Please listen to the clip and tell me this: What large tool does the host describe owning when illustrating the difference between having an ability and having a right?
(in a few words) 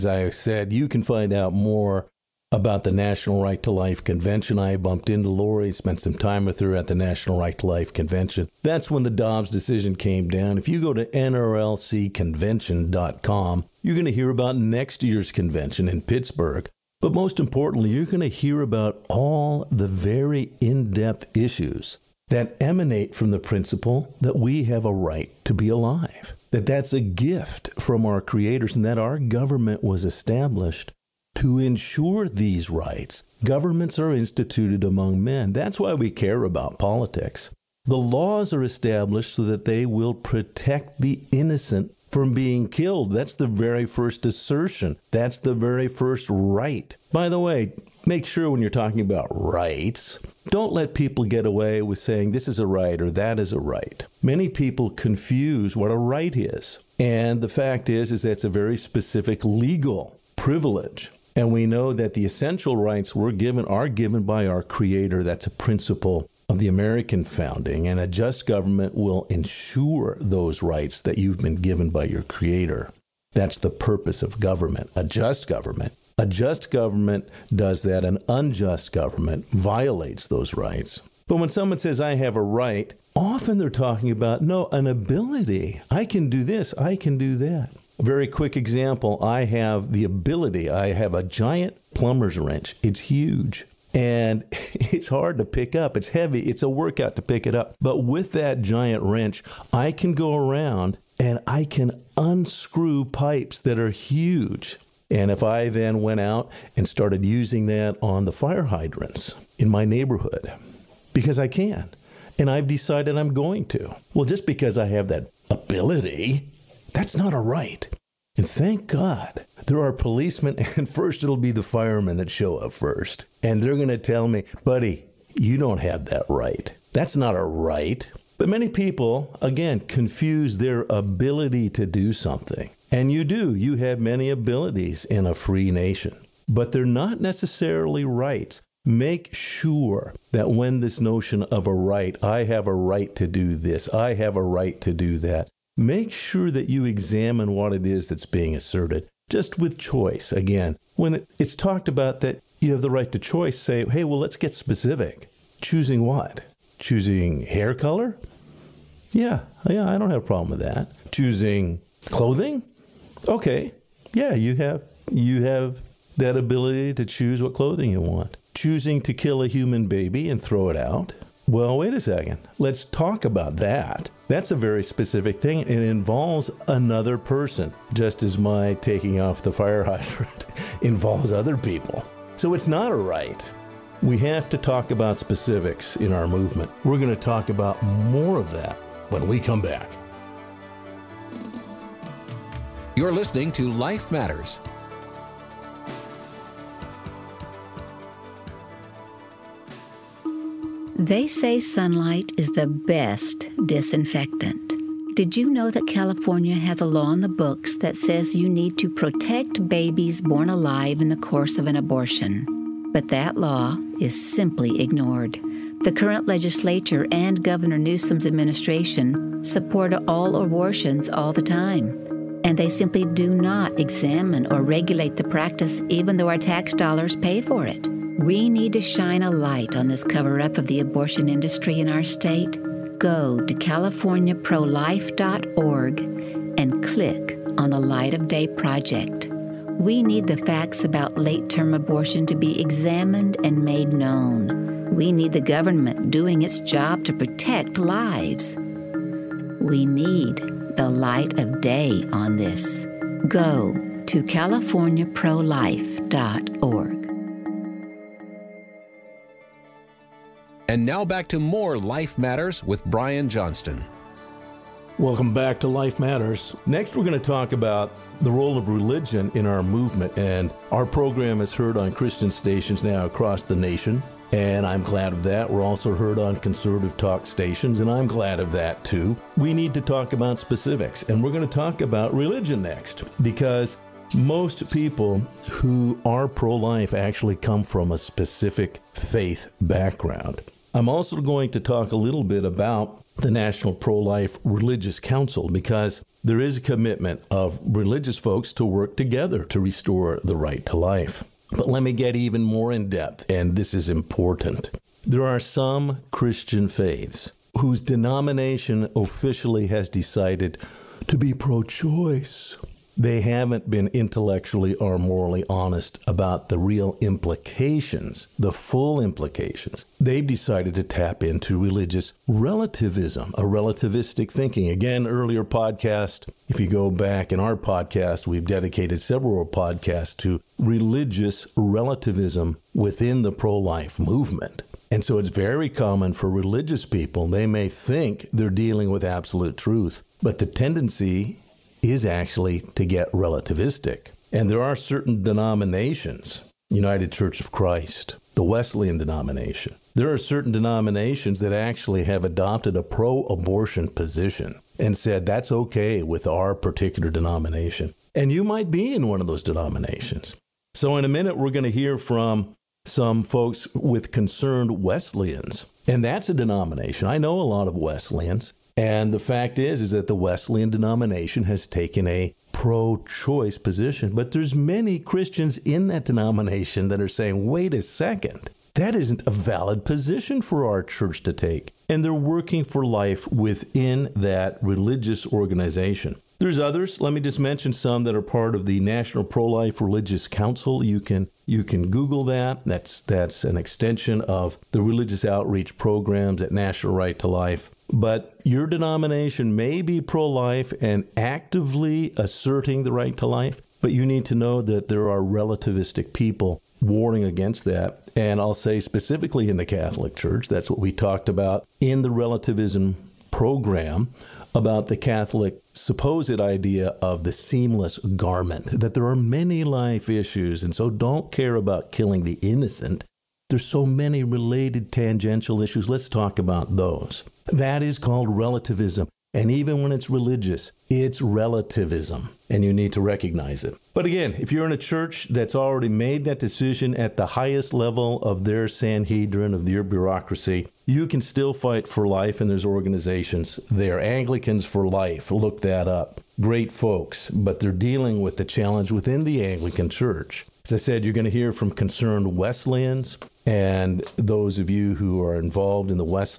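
plumber's wrench.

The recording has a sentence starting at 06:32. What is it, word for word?
That's that's an extension of the religious outreach programs at National Right to Life.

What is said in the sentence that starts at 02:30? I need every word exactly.
Again, when it's talked about that you have the right to choice, say, hey, well, let's get specific.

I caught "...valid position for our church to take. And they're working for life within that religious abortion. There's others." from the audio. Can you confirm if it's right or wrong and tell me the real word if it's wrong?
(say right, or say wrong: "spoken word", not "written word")
wrong: "organization", not "abortion".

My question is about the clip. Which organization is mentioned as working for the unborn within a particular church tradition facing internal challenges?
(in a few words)
Anglicans for Life.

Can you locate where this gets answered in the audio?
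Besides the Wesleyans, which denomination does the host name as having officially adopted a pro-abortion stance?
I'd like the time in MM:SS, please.
05:46.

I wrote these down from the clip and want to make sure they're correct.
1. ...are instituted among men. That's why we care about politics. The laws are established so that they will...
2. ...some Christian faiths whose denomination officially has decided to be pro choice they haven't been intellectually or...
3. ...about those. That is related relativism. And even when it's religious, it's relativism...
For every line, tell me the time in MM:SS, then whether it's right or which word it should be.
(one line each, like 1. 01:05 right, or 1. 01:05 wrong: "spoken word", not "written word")
1. 00:33 right
2. 05:05 right
3. 07:06 wrong: "called", not "related".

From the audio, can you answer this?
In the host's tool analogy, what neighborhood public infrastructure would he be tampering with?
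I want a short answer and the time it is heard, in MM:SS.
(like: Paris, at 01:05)
fire hydrants, at 01:48.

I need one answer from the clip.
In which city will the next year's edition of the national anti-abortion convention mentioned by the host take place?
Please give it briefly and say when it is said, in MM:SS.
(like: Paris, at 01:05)
Pittsburgh, at 00:16.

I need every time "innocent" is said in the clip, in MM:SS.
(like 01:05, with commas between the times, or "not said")
00:41, 07:02.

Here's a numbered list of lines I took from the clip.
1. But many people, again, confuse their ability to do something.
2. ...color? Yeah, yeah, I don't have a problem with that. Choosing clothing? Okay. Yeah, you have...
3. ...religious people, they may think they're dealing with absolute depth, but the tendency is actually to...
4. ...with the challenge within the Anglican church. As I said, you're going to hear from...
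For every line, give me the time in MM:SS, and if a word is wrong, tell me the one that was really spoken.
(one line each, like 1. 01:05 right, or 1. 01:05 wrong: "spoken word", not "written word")
1. 02:08 right
2. 02:37 right
3. 05:36 wrong: "truth", not "depth"
4. 07:28 right.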